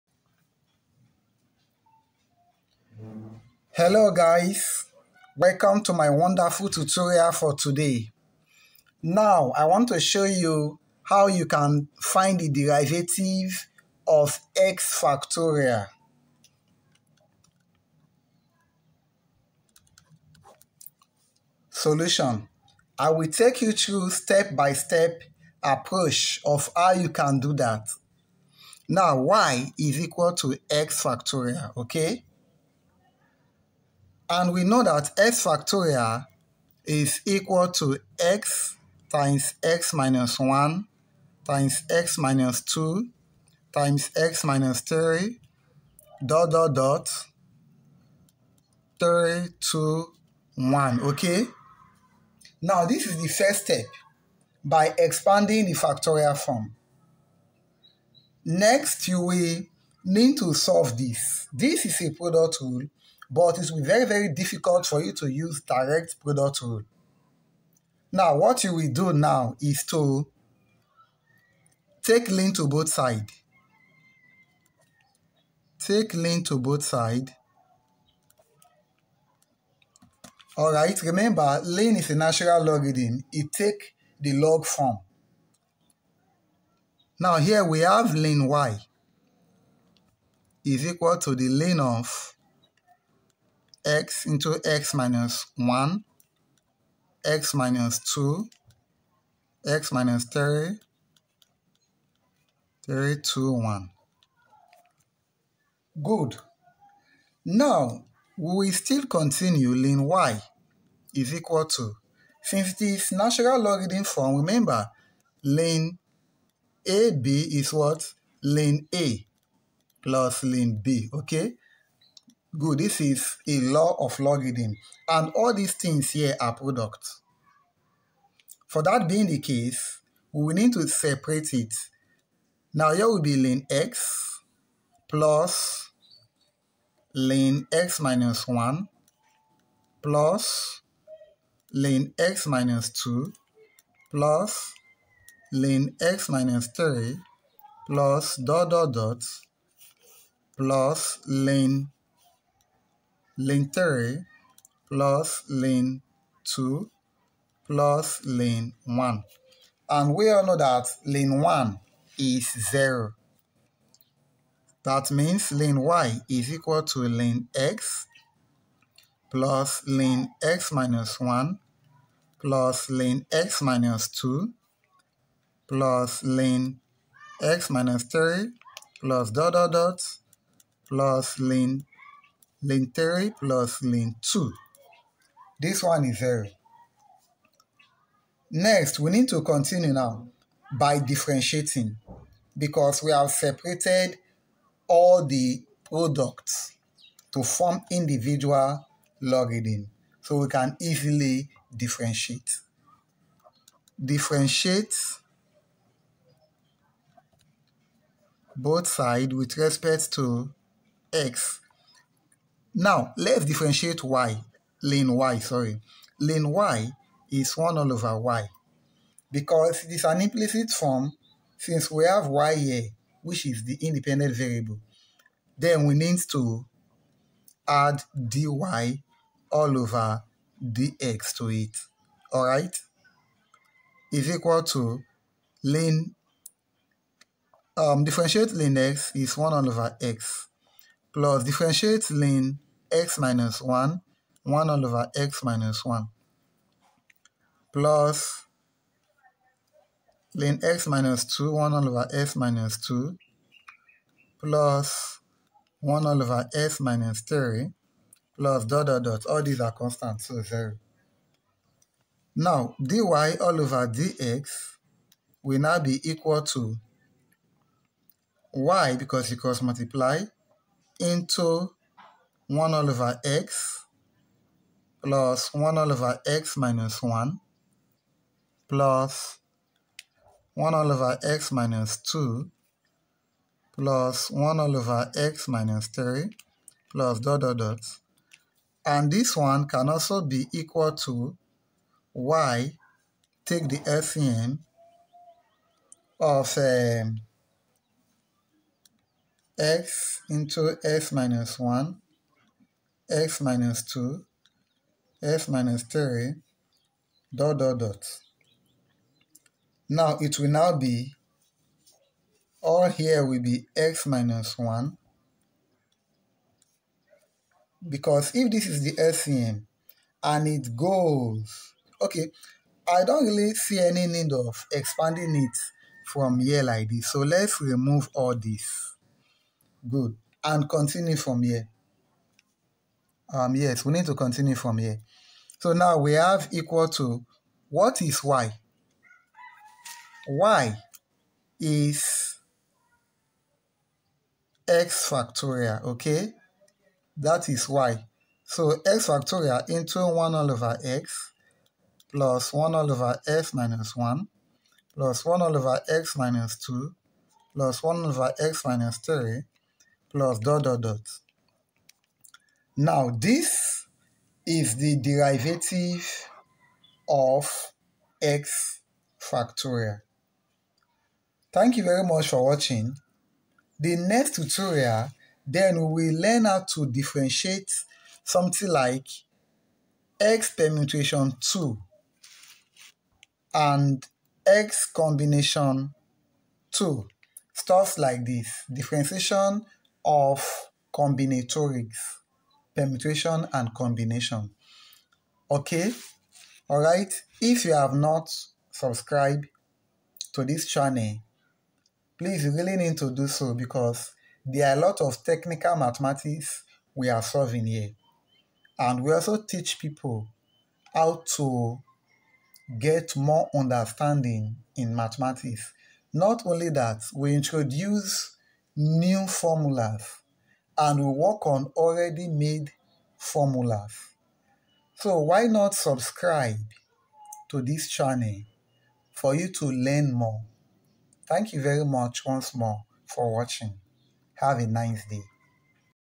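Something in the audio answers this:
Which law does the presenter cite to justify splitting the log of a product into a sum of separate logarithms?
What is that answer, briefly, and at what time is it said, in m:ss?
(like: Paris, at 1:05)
law of logarithm, at 2:03.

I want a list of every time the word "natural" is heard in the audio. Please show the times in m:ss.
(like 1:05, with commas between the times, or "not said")
1:22, 1:53.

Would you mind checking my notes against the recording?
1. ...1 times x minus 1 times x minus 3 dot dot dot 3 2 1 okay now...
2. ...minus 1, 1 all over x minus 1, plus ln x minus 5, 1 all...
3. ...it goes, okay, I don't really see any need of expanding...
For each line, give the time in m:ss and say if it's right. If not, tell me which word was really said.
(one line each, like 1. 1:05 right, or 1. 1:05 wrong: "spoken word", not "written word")
1. 0:40 wrong: "2", not "1"
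2. 4:03 wrong: "2", not "5"
3. 5:20 right.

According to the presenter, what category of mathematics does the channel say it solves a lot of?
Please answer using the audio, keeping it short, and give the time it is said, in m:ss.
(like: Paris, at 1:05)
technical mathematics, at 6:45.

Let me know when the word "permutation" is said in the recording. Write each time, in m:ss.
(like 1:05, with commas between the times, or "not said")
6:20, 6:32.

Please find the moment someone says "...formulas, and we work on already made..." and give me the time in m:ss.
6:59.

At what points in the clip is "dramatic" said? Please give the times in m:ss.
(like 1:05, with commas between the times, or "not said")
not said.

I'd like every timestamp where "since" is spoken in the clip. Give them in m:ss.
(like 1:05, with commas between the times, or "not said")
1:52, 3:41.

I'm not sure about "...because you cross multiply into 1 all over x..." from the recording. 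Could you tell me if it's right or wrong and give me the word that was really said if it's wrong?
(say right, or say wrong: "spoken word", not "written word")
right.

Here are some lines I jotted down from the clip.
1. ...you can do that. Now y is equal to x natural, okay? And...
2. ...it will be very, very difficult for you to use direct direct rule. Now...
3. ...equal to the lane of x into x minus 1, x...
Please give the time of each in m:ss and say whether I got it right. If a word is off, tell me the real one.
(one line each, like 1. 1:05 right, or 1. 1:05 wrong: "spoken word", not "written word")
1. 0:26 wrong: "factorial", not "natural"
2. 1:03 wrong: "product", not "direct"
3. 1:30 right.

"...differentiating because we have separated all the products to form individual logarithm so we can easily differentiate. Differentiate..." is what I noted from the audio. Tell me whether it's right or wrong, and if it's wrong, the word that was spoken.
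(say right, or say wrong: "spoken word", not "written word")
right.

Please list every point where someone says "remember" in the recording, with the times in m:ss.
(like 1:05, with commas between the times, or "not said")
1:21, 1:54.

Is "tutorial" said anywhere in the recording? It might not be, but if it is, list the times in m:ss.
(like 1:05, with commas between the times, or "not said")
0:06, 6:14.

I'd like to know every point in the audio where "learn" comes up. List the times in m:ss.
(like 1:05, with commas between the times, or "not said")
6:16, 7:09.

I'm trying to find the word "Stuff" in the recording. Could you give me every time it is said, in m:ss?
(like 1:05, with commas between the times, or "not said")
6:27.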